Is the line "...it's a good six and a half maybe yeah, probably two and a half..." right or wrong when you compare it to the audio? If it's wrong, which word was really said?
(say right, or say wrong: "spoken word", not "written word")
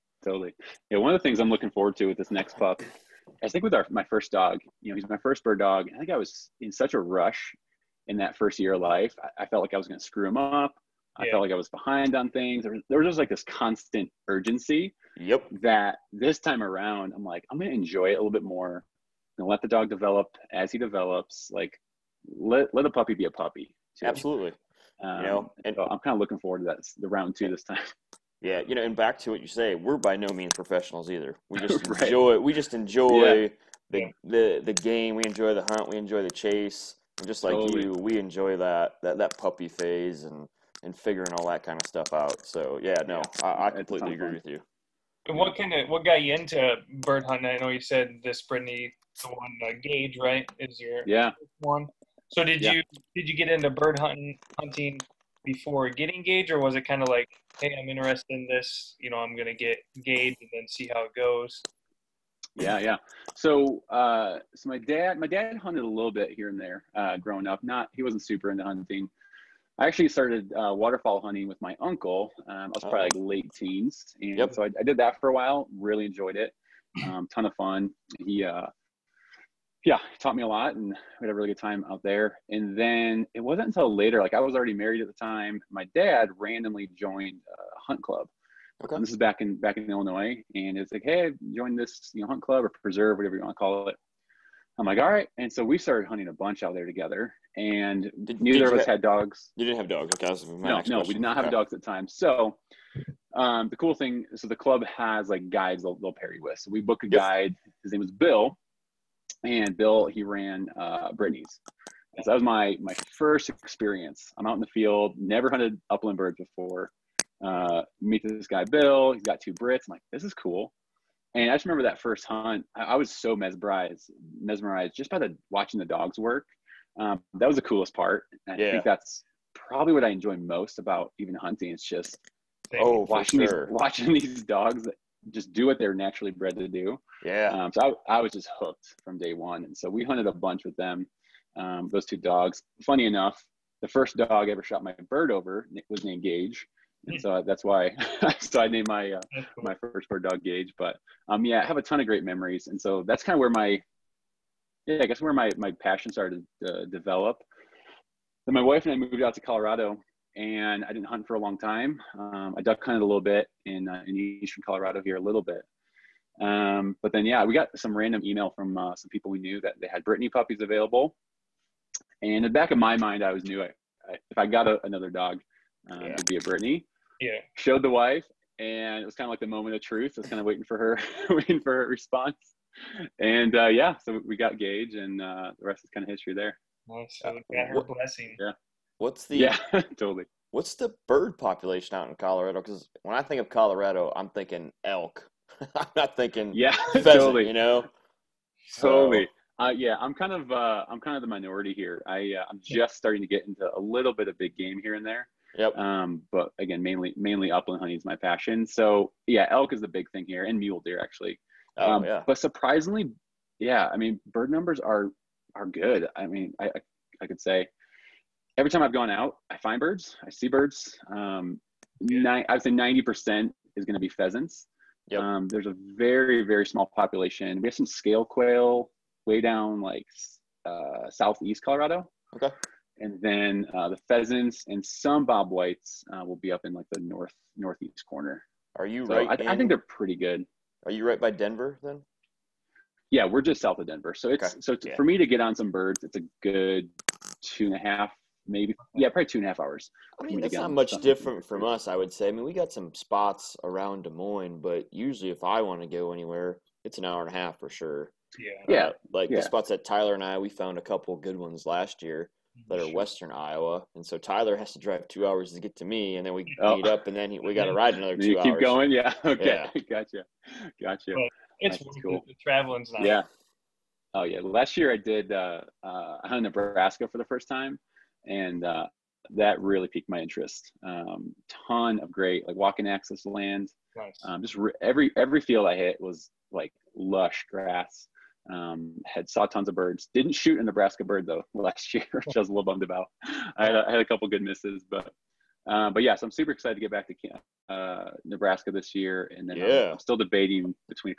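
wrong: "two", not "six".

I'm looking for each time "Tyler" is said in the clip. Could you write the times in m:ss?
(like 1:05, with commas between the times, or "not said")
4:19, 4:24.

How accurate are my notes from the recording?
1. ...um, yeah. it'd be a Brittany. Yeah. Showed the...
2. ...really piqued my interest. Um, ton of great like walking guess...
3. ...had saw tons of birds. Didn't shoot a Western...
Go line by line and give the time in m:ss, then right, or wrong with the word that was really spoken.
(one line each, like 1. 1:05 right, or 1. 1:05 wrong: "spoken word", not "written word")
1. 2:55 right
2. 4:39 wrong: "access", not "guess"
3. 4:49 wrong: "Nebraska", not "Western".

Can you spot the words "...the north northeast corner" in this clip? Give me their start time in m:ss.
3:56.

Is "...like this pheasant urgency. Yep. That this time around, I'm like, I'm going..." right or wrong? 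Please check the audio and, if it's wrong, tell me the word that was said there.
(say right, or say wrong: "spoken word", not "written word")
wrong: "constant", not "pheasant".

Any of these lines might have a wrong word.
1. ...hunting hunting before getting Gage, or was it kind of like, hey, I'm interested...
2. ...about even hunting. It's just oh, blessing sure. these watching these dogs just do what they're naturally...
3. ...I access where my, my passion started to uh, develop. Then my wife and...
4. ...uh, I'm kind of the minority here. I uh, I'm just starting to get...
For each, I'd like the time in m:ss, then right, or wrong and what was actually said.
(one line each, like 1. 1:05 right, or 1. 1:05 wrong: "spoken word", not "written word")
1. 0:53 right
2. 2:10 wrong: "watching", not "blessing"
3. 2:35 wrong: "guess", not "access"
4. 3:20 right.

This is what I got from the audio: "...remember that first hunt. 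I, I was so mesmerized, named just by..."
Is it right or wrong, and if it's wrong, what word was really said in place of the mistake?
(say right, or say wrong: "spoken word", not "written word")
wrong: "mesmerized", not "named".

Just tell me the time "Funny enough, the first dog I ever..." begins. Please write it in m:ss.
2:22.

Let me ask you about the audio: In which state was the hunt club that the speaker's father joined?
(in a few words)
Illinois.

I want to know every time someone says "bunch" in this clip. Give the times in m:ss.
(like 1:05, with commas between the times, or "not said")
1:36, 2:20.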